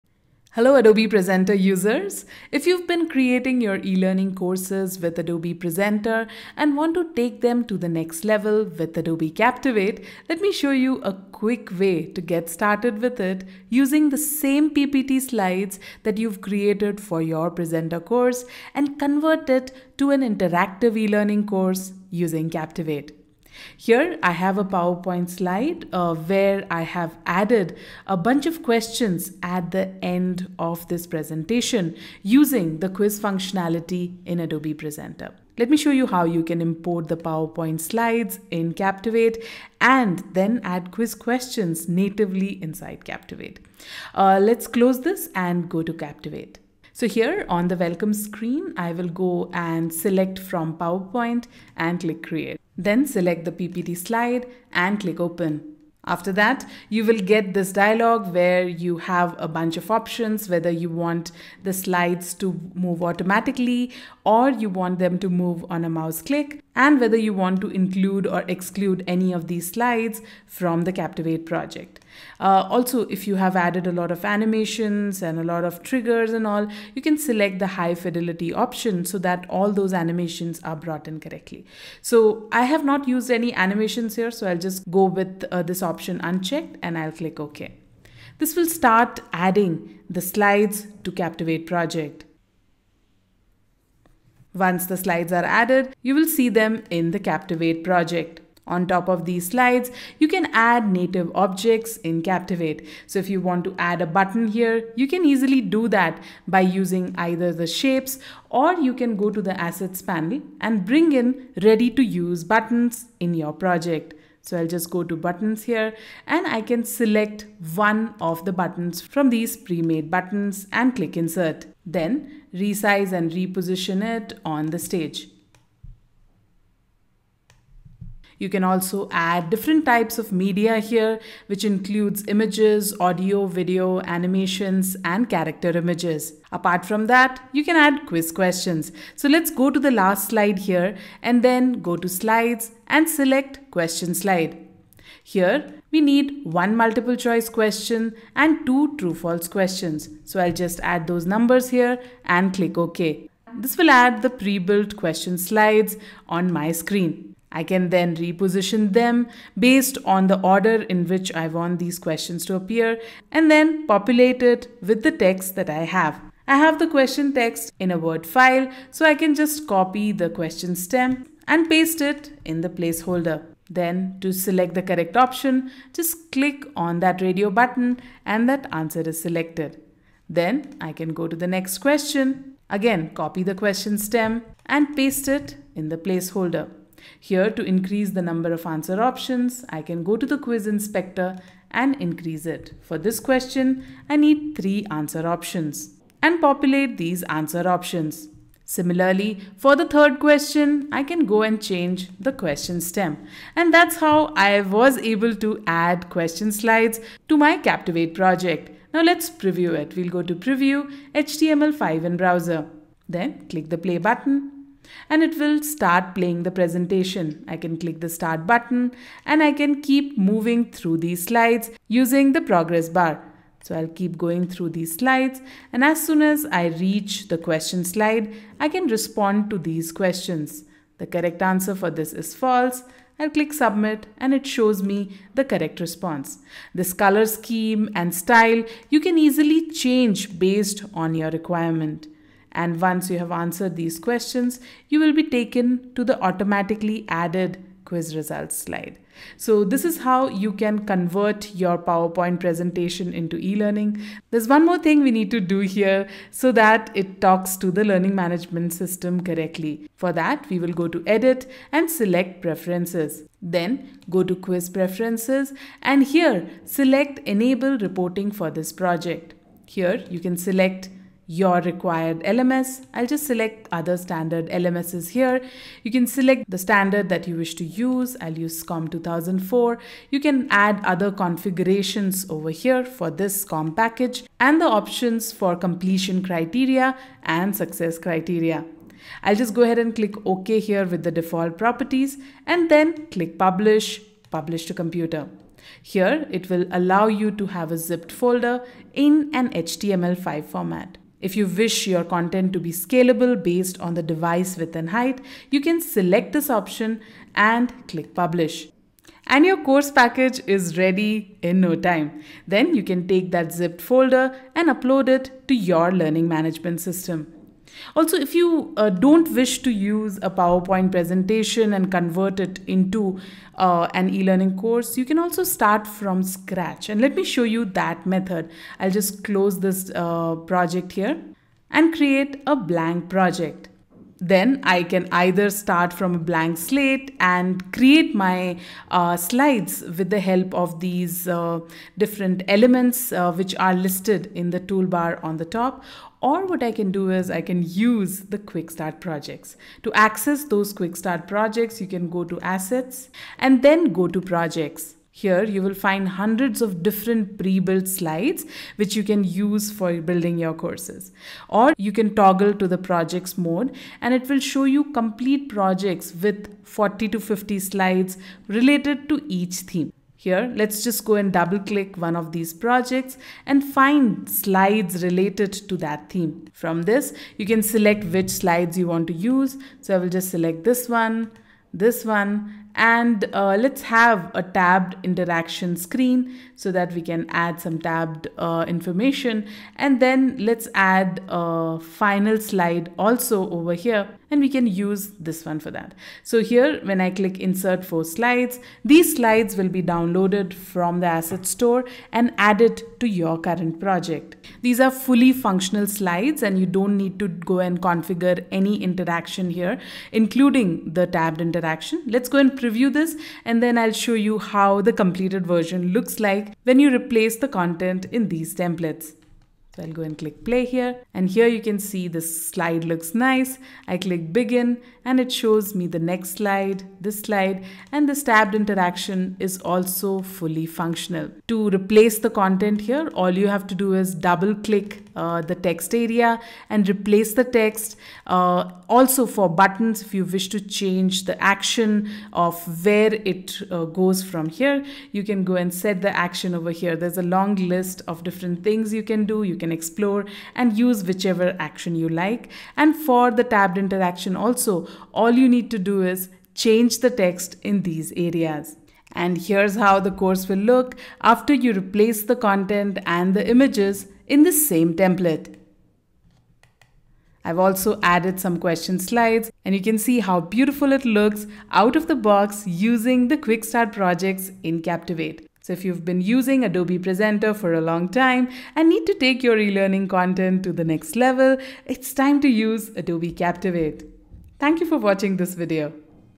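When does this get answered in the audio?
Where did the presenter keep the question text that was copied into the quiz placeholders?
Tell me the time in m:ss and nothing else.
2:47.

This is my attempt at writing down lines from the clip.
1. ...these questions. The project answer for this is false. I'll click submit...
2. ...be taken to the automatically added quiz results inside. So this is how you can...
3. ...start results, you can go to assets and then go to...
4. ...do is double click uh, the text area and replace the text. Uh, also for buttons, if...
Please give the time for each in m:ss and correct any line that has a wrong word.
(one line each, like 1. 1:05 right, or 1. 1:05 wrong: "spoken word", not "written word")
1. 3:49 wrong: "correct", not "project"
2. 4:05 wrong: "slide", not "inside"
3. 5:50 wrong: "projects", not "results"
4. 7:13 right.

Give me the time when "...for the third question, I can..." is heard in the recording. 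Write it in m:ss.
3:19.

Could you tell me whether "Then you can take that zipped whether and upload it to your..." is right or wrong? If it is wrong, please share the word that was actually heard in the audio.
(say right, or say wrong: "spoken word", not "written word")
wrong: "folder", not "whether".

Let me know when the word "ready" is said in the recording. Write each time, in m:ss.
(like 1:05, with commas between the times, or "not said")
1:51, 5:10.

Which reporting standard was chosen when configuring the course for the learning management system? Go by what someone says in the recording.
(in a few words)
SCORM 2004.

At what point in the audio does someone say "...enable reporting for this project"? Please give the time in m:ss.
4:27.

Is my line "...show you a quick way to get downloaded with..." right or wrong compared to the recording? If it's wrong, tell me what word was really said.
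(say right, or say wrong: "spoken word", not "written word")
wrong: "started", not "downloaded".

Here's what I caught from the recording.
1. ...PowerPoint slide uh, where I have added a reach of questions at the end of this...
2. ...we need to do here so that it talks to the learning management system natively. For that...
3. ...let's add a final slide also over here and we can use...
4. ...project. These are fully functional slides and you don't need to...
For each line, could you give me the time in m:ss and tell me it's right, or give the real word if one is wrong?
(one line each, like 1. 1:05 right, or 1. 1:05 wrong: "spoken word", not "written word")
1. 0:24 wrong: "bunch", not "reach"
2. 4:15 wrong: "correctly", not "natively"
3. 6:30 right
4. 6:43 right.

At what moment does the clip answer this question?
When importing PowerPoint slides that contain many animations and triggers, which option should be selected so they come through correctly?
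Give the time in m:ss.
1:17.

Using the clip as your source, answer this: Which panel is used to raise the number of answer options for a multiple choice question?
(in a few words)
Quiz inspector.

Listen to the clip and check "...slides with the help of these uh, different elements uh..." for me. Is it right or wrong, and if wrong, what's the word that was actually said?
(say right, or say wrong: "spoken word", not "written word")
right.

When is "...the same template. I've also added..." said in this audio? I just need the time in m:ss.
7:44.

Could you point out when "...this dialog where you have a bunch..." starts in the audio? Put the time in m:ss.
0:57.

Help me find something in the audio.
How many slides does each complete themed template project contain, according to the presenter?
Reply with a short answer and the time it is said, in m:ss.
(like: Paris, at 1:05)
40 to 50, at 6:06.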